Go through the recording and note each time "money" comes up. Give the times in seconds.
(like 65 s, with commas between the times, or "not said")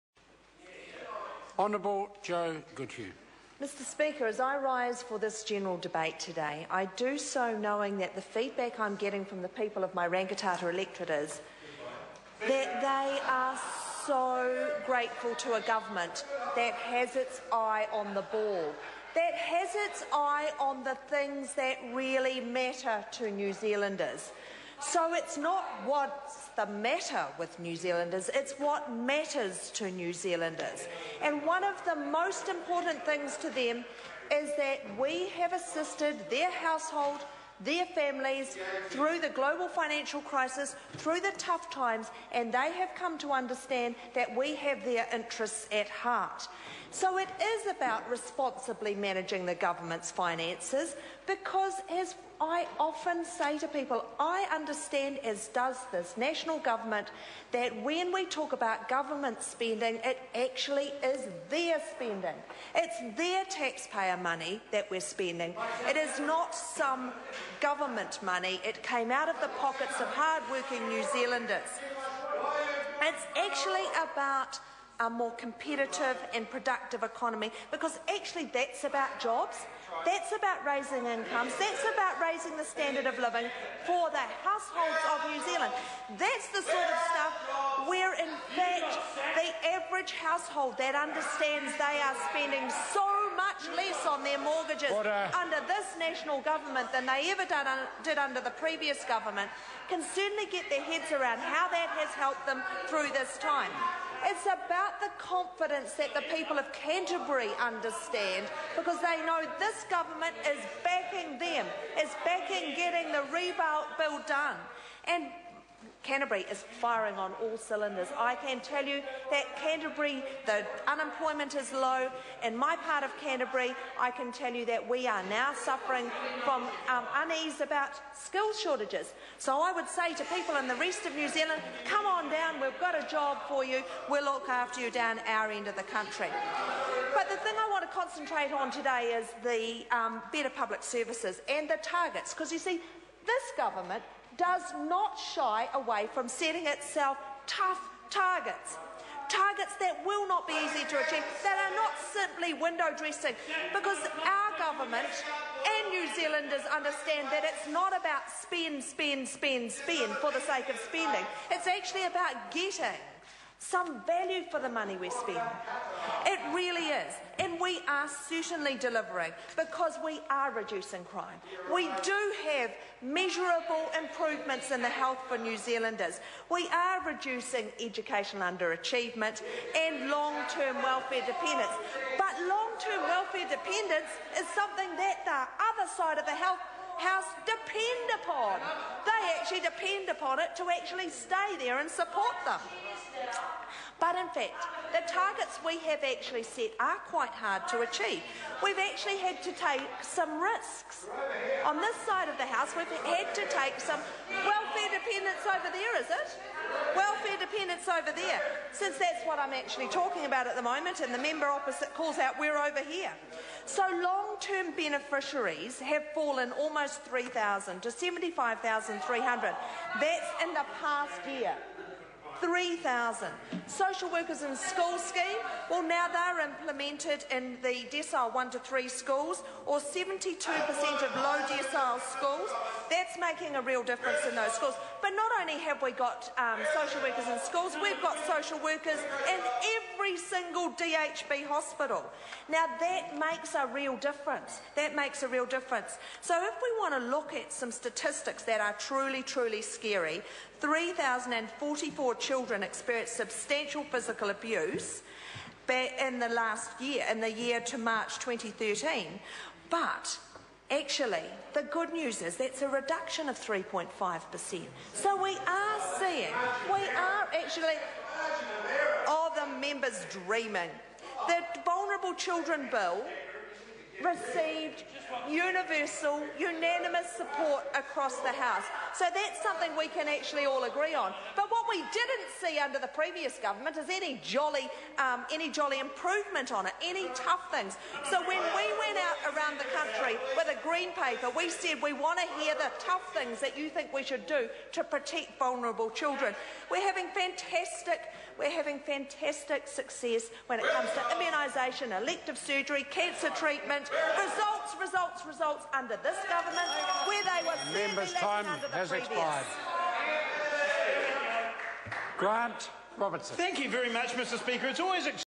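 64 s, 68 s, 164 s.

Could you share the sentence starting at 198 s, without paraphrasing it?
We've actually had to take some risks.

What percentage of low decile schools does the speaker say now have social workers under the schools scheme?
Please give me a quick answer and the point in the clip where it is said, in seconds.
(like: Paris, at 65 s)
72%, at 229 s.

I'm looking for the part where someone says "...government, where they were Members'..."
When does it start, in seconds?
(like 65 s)
306 s.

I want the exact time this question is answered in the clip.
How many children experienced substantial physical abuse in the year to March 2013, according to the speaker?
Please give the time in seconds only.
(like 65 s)
250 s.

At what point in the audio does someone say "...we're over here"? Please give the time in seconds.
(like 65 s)
212 s.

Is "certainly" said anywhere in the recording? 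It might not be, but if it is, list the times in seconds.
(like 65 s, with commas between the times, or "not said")
100 s, 168 s.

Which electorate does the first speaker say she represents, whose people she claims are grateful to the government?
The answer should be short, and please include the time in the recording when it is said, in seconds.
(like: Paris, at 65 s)
Rangitata, at 10 s.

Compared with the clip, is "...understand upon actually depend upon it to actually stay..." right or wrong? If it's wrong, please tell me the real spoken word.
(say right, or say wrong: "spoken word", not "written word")
wrong: "depend", not "understand".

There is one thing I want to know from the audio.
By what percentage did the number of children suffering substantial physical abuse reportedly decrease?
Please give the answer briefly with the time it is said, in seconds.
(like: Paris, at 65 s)
3.5%, at 263 s.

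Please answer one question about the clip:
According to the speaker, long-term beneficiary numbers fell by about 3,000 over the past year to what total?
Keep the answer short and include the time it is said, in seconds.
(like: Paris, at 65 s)
75,300, at 217 s.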